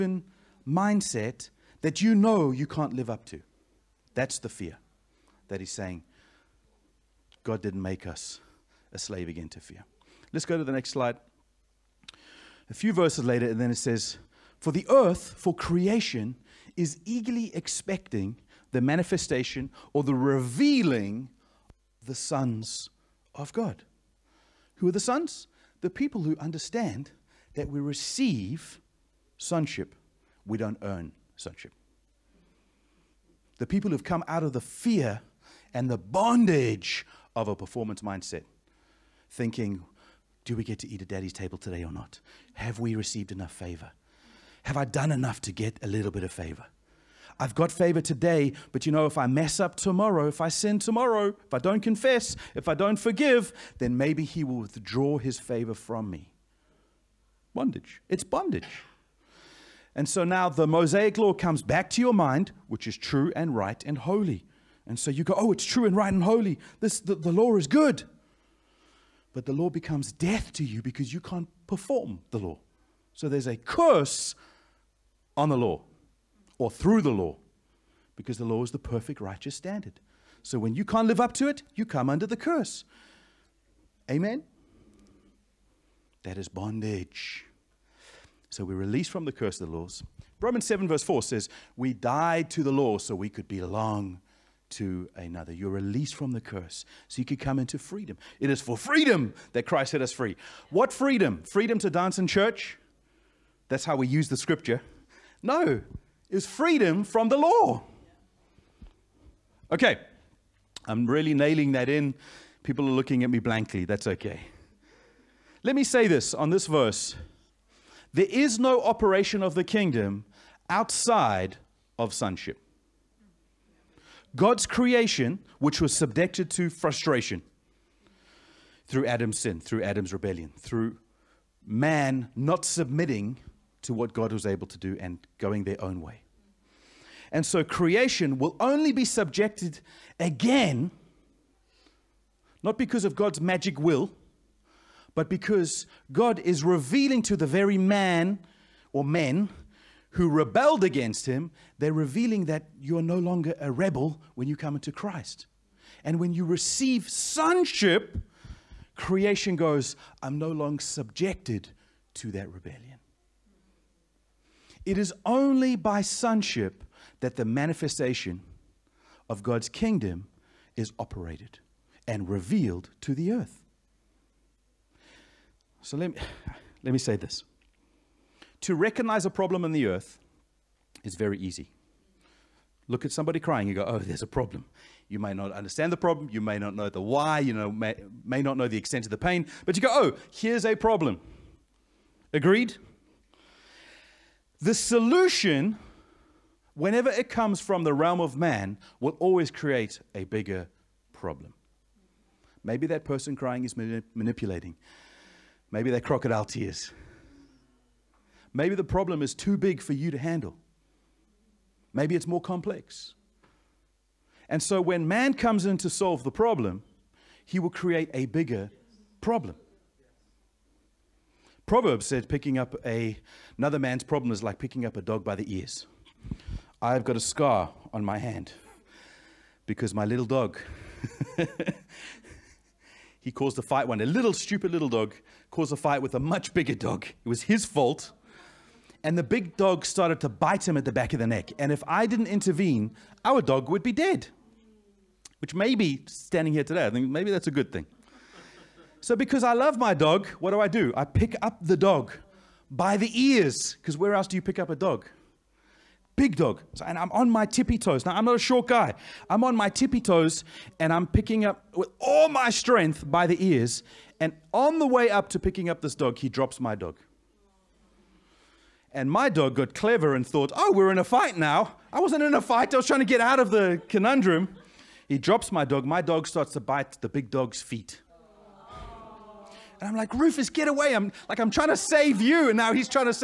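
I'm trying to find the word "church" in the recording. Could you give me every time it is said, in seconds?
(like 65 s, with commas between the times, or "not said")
102 s.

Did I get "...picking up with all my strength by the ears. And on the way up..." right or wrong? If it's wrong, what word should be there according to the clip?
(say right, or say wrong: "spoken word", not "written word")
right.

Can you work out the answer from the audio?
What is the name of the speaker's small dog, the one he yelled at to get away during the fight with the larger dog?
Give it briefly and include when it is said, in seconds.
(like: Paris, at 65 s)
Rufus, at 280 s.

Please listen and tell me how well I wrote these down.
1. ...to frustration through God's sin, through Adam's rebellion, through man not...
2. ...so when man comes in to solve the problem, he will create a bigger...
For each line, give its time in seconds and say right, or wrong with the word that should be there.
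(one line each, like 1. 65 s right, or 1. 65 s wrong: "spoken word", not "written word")
1. 126 s wrong: "Adam", not "God"
2. 214 s right.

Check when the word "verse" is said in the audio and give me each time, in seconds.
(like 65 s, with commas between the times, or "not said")
12 s, 90 s, 116 s.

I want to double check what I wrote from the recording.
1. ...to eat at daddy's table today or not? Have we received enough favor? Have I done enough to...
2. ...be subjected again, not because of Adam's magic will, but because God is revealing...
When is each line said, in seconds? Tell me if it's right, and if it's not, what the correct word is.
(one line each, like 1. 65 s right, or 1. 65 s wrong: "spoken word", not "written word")
1. 40 s right
2. 138 s wrong: "God", not "Adam".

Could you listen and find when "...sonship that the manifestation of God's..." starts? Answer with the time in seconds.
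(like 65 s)
166 s.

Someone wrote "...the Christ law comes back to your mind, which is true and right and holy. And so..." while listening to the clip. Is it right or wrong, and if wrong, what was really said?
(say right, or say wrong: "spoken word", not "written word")
wrong: "Mosaic", not "Christ".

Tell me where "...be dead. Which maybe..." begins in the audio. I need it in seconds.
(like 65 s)
243 s.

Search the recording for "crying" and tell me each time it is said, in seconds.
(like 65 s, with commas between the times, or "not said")
183 s, 203 s.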